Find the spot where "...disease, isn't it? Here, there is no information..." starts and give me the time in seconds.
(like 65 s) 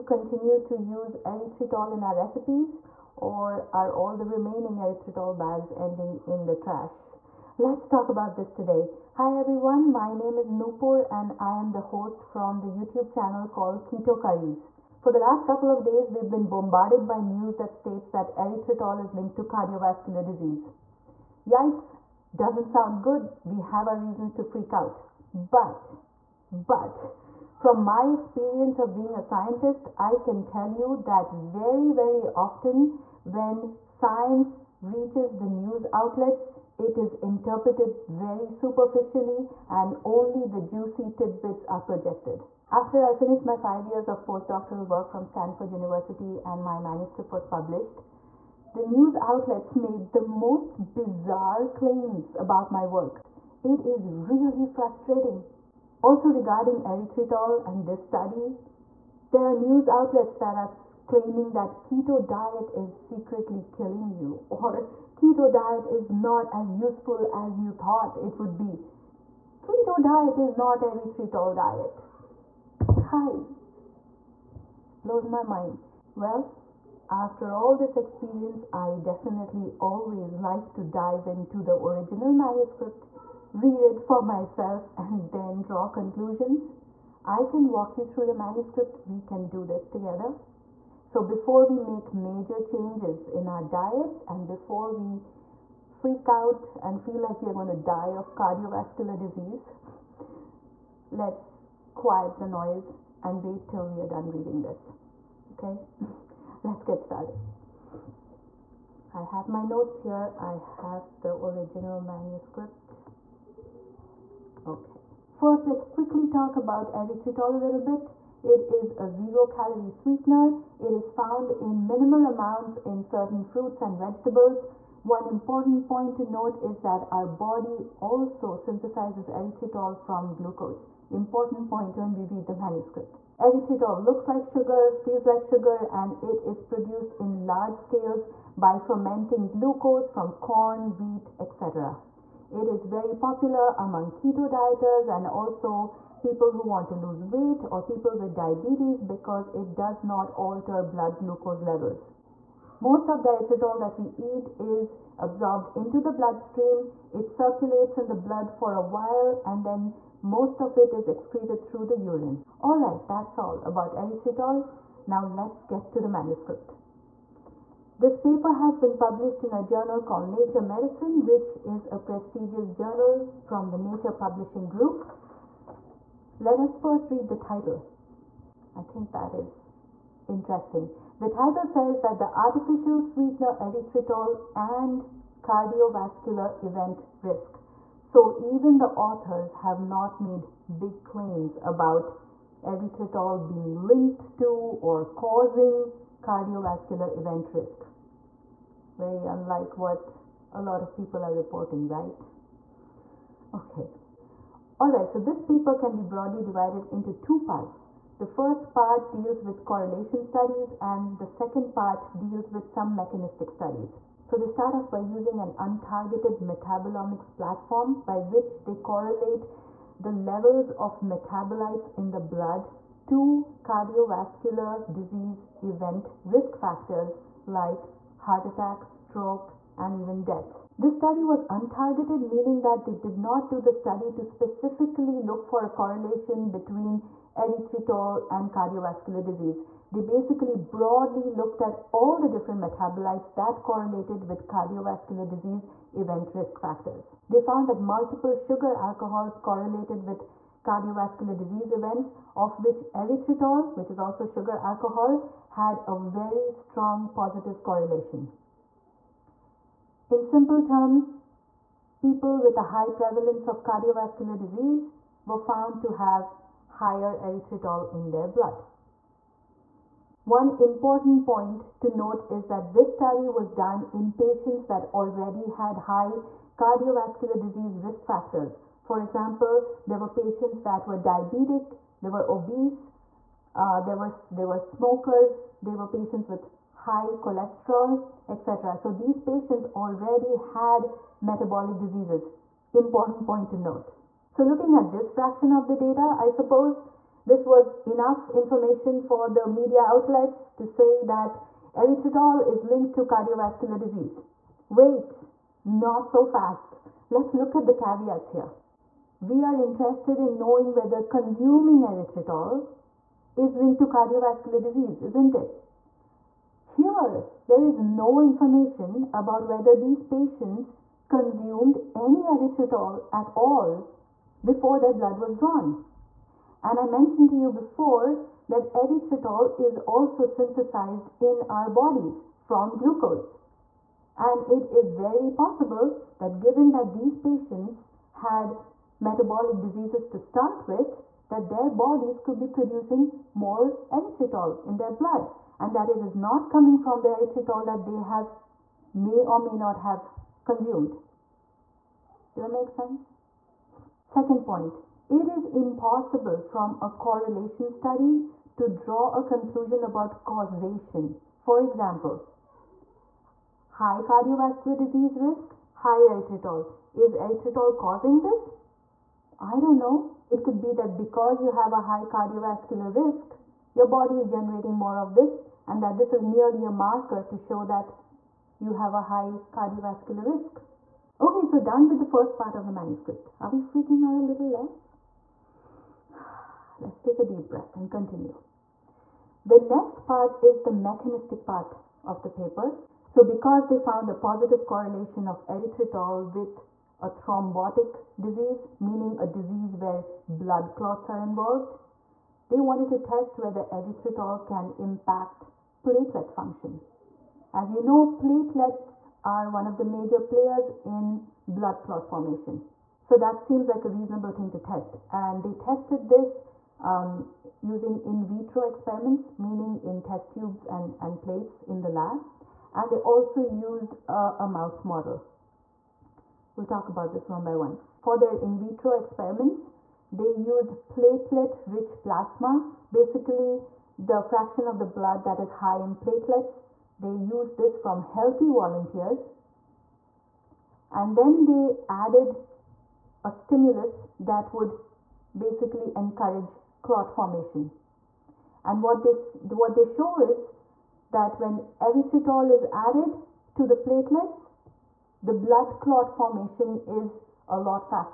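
314 s.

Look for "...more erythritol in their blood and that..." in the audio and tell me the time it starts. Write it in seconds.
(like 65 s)
343 s.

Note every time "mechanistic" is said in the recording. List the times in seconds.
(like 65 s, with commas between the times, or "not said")
212 s, 390 s.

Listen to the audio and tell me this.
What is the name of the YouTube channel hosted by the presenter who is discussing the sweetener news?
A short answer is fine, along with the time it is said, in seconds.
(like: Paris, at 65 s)
Keto Curries, at 13 s.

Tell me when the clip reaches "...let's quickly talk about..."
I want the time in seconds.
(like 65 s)
115 s.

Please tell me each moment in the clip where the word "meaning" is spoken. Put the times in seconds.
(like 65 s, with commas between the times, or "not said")
232 s, 398 s, 419 s.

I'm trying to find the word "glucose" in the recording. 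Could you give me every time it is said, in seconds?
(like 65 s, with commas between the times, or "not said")
130 s, 139 s, 151 s, 332 s.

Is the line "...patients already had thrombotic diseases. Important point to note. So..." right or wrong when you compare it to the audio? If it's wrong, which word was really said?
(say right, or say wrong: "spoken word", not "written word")
wrong: "metabolic", not "thrombotic".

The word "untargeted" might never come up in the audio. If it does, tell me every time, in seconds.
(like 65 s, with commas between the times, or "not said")
215 s, 231 s.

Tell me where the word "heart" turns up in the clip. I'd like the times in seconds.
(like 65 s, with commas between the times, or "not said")
228 s.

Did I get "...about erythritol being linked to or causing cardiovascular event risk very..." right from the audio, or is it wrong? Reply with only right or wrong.
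right.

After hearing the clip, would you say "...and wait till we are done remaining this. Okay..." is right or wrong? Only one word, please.
wrong.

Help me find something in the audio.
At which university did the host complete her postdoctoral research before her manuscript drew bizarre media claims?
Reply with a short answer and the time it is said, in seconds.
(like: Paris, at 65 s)
Stanford University, at 45 s.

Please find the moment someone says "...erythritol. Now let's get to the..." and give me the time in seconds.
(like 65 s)
163 s.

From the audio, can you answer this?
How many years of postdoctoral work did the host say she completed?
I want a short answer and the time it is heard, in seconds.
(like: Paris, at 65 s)
5, at 43 s.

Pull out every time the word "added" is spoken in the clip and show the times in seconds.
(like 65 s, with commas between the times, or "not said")
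441 s, 452 s.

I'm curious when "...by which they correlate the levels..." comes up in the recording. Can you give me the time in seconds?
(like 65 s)
218 s.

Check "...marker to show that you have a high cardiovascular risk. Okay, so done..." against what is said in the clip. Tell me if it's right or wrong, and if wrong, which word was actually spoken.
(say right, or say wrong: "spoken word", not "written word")
right.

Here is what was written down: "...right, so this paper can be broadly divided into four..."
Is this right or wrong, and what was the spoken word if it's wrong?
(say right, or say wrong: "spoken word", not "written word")
wrong: "two", not "four".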